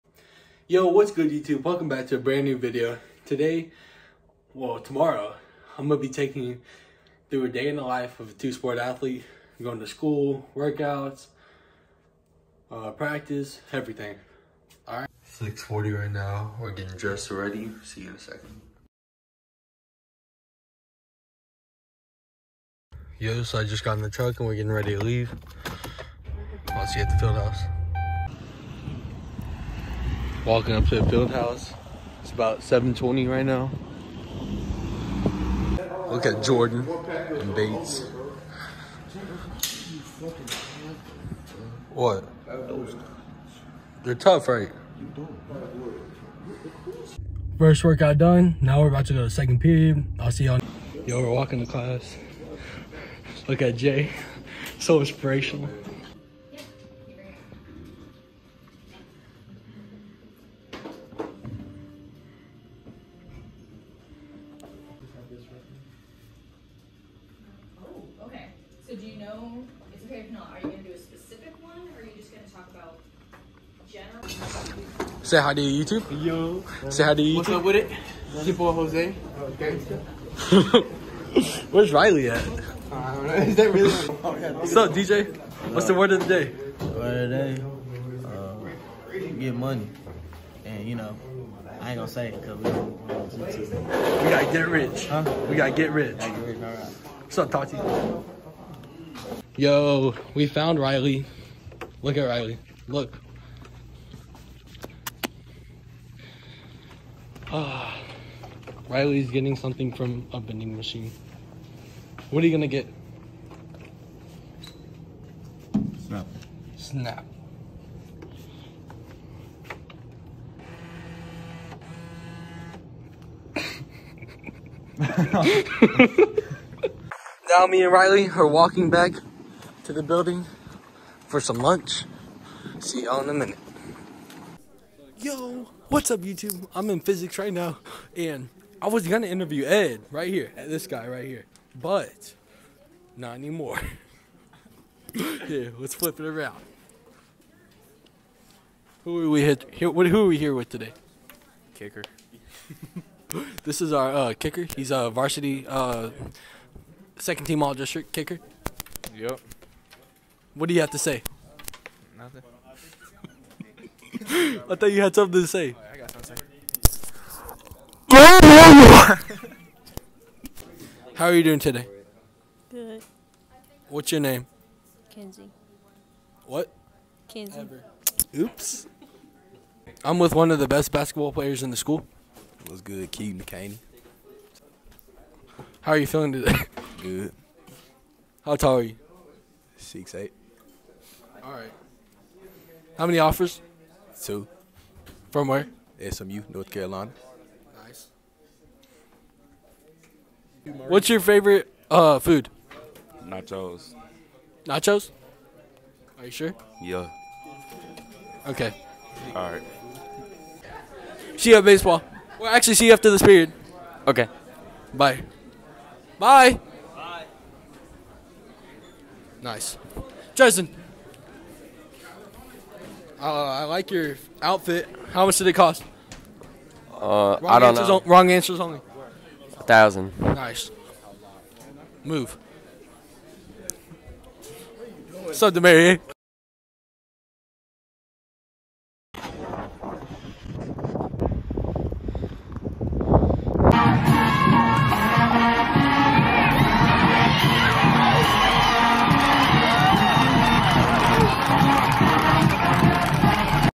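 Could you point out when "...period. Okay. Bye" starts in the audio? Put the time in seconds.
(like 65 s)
213 s.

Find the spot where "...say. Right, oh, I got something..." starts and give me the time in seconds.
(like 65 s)
165 s.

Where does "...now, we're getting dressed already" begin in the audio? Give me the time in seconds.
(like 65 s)
16 s.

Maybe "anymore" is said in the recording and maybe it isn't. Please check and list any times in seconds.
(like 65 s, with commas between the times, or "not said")
143 s.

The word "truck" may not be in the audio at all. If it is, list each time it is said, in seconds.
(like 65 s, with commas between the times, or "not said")
24 s.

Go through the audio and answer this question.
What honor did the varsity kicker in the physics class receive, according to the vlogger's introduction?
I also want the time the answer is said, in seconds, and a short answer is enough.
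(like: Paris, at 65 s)
Second team all district, at 157 s.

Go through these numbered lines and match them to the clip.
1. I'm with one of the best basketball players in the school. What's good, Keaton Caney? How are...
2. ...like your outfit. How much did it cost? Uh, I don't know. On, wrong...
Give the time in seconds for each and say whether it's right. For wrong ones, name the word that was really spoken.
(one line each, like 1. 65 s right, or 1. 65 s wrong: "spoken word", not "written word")
1. 180 s right
2. 223 s right.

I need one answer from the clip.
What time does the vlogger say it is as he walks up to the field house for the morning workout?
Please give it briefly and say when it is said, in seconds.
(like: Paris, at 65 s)
7:20, at 32 s.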